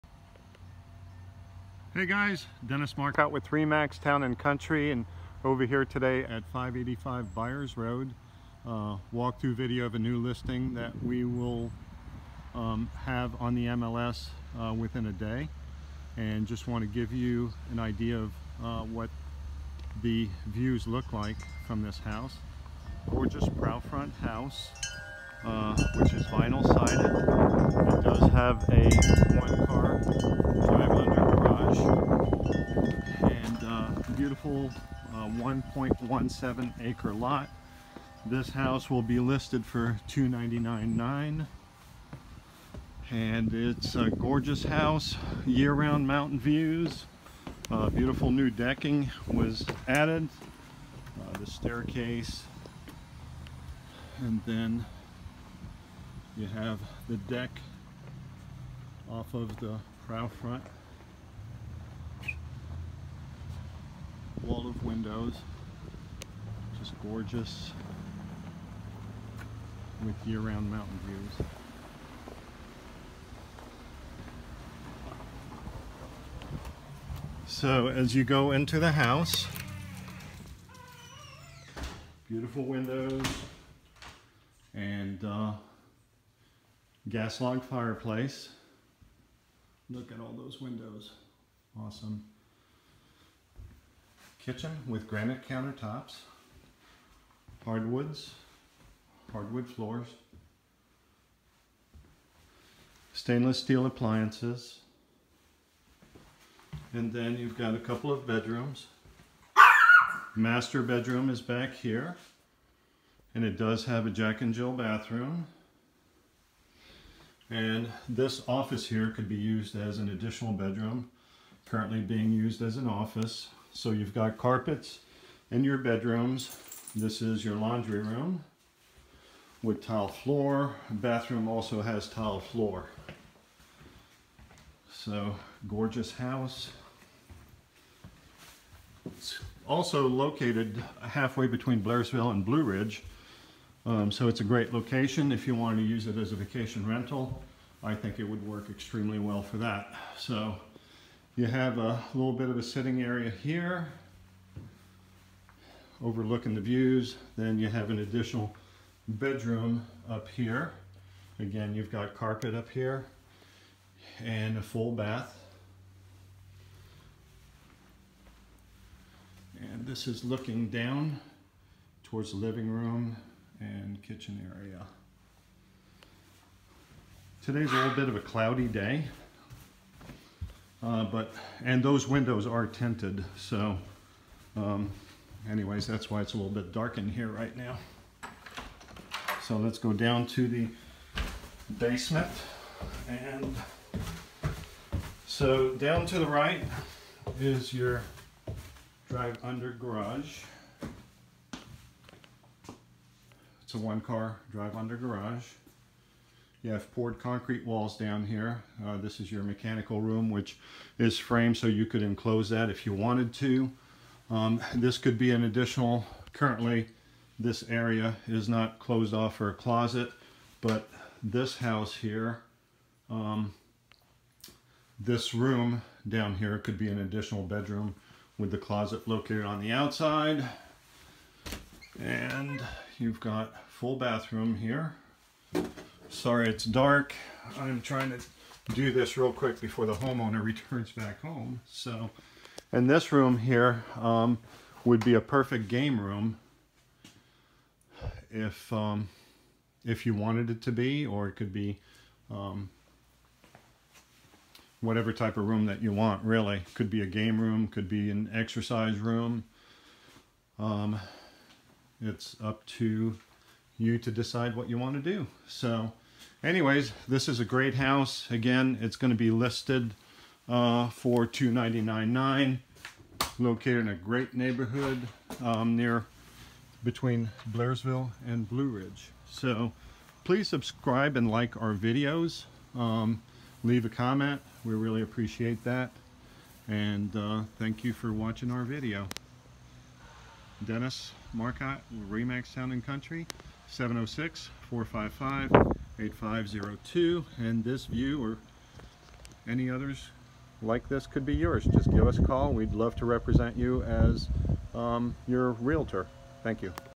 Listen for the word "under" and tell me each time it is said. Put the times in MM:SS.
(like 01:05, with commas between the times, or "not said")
03:19, 03:24.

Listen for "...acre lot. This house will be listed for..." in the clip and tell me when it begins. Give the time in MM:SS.
00:36.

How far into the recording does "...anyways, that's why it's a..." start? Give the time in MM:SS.
03:05.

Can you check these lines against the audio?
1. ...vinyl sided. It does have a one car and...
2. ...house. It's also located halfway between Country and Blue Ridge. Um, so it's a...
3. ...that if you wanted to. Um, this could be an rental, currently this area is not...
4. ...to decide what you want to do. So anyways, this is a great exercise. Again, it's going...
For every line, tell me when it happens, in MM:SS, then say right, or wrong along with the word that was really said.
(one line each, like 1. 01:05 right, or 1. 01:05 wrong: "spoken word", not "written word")
1. 00:26 right
2. 02:16 wrong: "Blairsville", not "Country"
3. 03:32 wrong: "additional", not "rental"
4. 04:23 wrong: "house", not "exercise".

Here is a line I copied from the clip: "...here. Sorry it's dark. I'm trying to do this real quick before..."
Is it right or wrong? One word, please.
right.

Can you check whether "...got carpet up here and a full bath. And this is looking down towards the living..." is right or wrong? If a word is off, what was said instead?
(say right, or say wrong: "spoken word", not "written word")
right.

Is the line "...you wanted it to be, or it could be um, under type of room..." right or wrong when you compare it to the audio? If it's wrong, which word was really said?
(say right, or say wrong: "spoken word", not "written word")
wrong: "whatever", not "under".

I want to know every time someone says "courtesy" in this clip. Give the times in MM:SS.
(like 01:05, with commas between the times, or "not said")
not said.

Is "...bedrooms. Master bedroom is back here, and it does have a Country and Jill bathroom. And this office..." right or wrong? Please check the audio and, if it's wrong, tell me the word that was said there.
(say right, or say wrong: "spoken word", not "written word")
wrong: "Jack", not "Country".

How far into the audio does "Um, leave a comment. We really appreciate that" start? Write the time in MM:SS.
04:42.